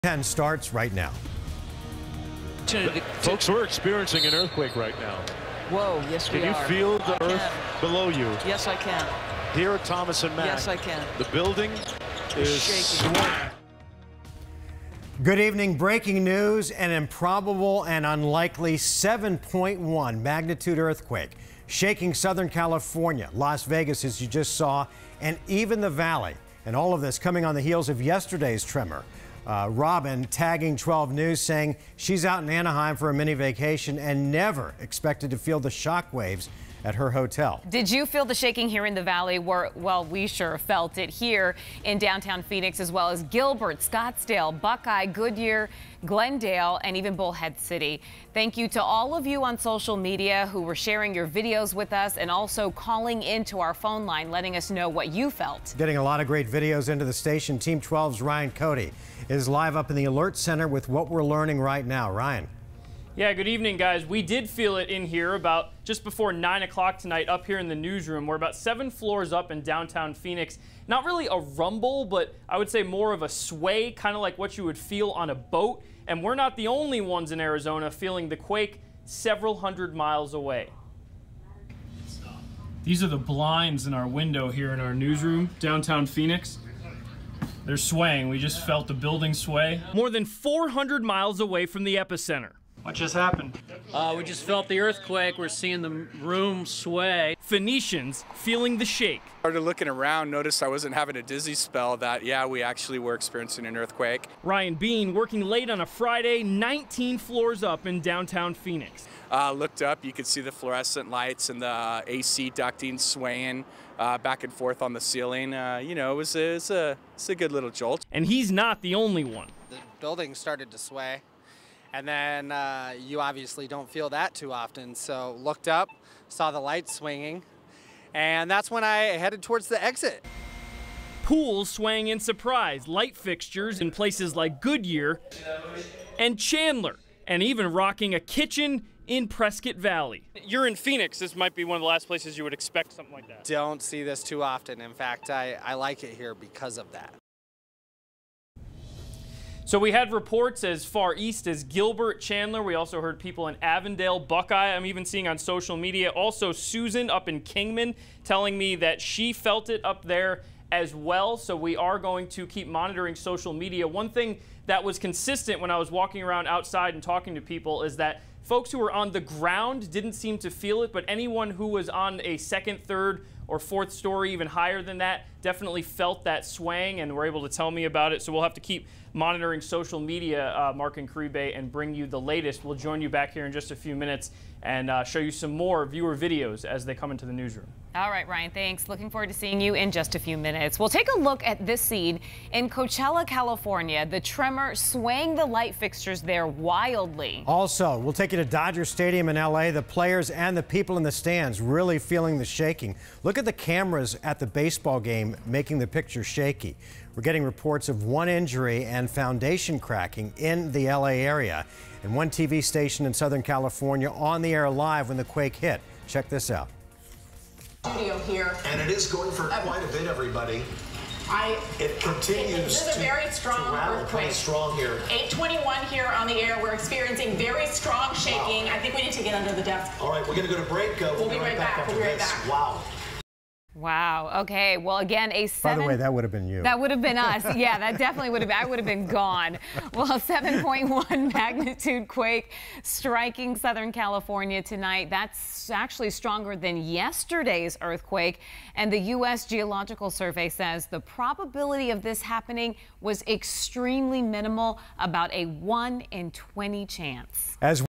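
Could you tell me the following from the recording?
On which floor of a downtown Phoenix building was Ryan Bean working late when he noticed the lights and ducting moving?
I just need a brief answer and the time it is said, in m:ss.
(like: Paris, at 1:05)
19, at 1:46.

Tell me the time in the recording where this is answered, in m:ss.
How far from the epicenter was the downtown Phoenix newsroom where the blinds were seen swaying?
1:29.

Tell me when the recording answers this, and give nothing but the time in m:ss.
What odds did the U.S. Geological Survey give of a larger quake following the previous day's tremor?
4:15.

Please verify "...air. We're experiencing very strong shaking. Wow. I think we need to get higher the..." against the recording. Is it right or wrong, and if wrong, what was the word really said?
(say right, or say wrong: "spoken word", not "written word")
wrong: "under", not "higher".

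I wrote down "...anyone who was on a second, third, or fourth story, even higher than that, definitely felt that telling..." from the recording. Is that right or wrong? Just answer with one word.
wrong.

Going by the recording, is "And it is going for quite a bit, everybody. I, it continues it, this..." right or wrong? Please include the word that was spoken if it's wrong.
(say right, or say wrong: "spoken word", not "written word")
right.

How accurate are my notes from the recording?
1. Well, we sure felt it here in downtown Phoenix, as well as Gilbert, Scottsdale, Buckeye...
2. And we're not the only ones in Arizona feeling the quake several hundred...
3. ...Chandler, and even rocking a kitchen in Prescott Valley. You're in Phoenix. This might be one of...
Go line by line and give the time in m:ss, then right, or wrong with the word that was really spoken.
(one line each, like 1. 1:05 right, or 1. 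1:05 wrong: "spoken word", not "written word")
1. 0:39 right
2. 1:16 right
3. 2:16 right.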